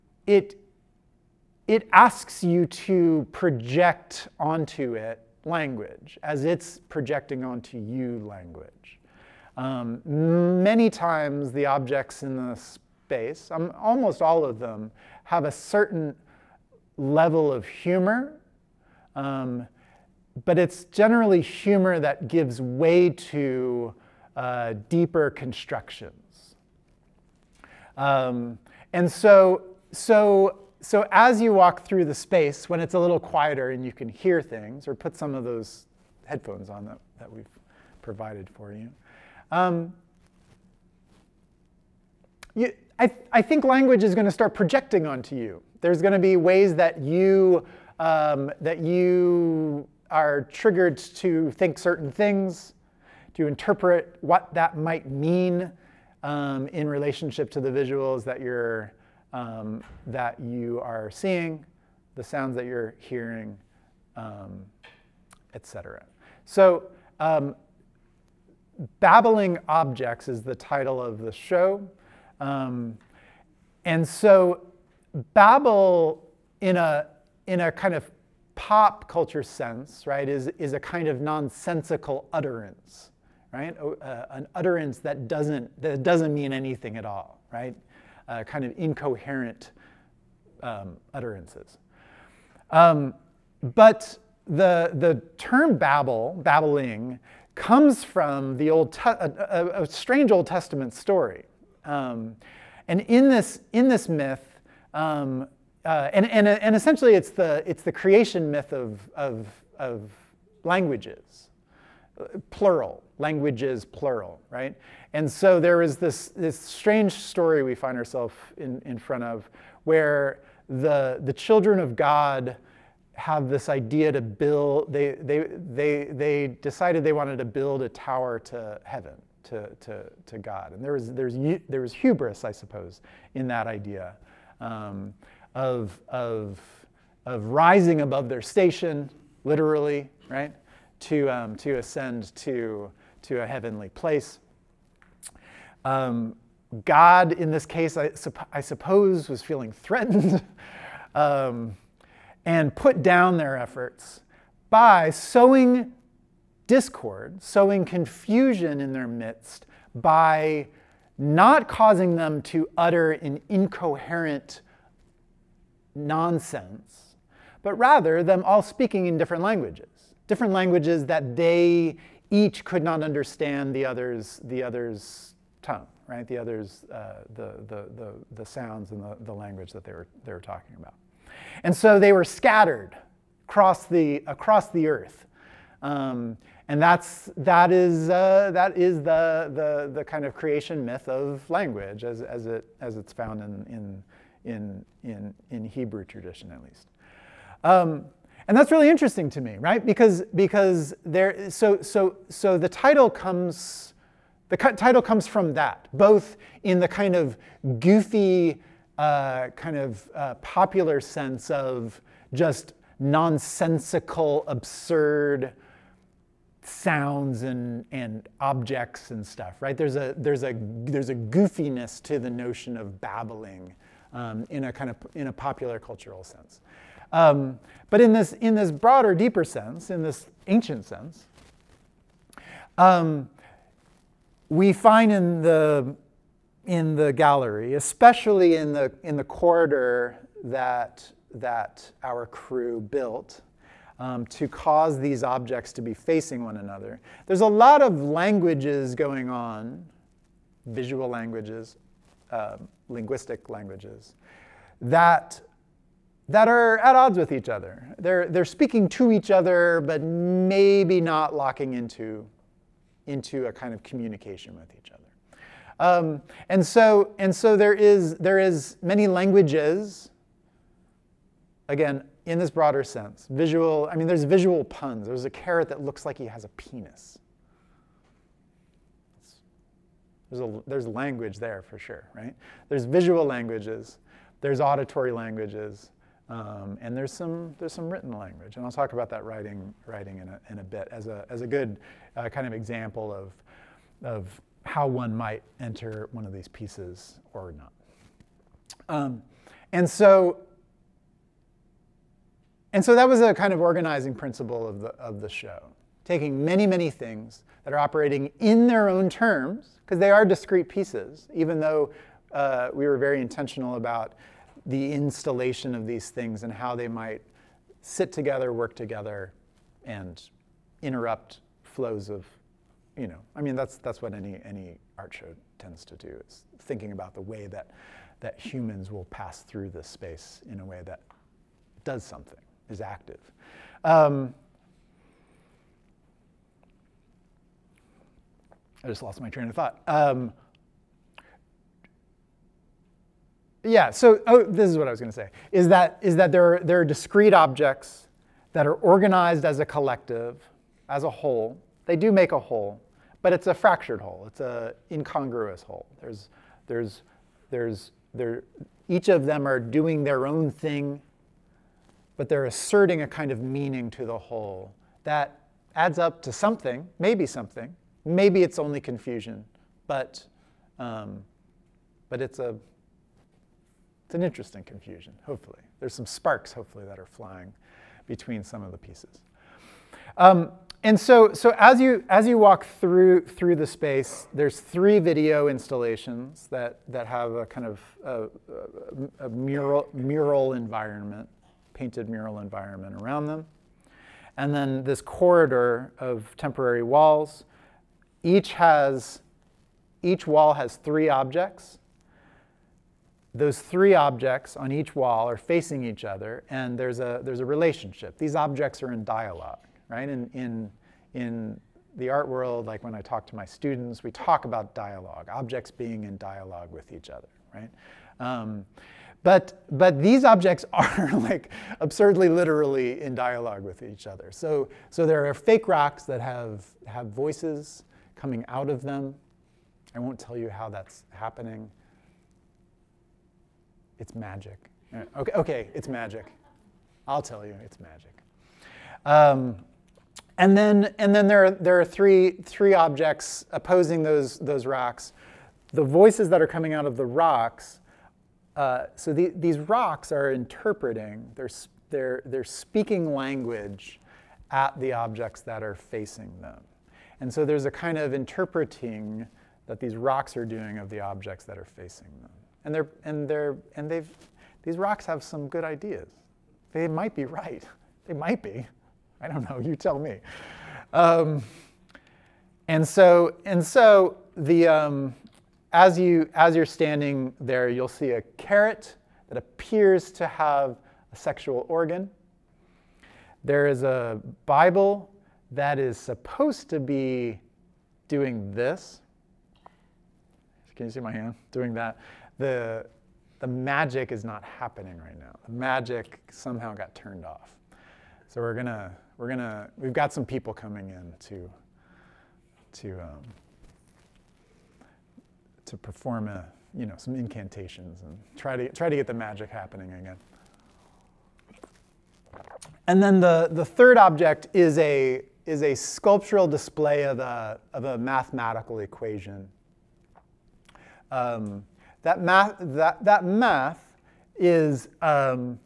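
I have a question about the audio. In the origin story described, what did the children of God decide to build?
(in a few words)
a tower to heaven.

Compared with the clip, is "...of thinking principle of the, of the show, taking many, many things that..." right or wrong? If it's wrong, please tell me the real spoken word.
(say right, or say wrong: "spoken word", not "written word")
wrong: "organizing", not "thinking".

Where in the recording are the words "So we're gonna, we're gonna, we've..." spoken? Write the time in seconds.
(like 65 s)
498 s.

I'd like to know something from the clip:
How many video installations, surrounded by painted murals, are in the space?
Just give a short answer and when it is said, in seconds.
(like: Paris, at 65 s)
3, at 384 s.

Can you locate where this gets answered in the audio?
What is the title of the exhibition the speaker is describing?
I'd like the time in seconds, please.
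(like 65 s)
68 s.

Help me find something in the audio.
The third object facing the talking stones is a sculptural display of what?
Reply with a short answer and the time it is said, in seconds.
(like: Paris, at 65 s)
a mathematical equation, at 517 s.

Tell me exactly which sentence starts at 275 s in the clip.
There's a carrot that looks like he has a penis.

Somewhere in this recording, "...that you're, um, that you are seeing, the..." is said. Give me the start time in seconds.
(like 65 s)
58 s.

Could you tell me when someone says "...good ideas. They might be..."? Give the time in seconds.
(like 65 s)
465 s.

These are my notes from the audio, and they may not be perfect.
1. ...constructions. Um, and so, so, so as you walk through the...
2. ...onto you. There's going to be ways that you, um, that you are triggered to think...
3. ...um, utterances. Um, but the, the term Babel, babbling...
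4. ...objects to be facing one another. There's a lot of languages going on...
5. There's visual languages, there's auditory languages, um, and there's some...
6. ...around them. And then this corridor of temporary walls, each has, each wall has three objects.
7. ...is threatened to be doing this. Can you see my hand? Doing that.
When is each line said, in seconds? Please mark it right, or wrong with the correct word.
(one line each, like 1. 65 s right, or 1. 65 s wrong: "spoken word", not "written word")
1. 25 s right
2. 45 s right
3. 90 s right
4. 245 s right
5. 282 s right
6. 393 s right
7. 485 s wrong: "supposed", not "threatened".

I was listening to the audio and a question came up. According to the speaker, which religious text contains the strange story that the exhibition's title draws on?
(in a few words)
Old Testament.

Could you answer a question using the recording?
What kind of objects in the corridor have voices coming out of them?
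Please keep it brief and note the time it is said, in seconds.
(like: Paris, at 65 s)
fake rocks, at 425 s.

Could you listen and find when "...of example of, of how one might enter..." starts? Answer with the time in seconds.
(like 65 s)
292 s.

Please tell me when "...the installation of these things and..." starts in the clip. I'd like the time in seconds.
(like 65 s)
314 s.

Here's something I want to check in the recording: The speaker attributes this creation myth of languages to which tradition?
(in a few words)
Hebrew tradition.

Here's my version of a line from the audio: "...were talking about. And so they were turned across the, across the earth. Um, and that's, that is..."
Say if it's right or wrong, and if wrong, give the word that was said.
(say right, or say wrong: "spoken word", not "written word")
wrong: "scattered", not "turned".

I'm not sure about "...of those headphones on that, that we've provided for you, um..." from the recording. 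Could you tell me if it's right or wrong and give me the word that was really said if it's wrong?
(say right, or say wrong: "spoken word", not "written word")
right.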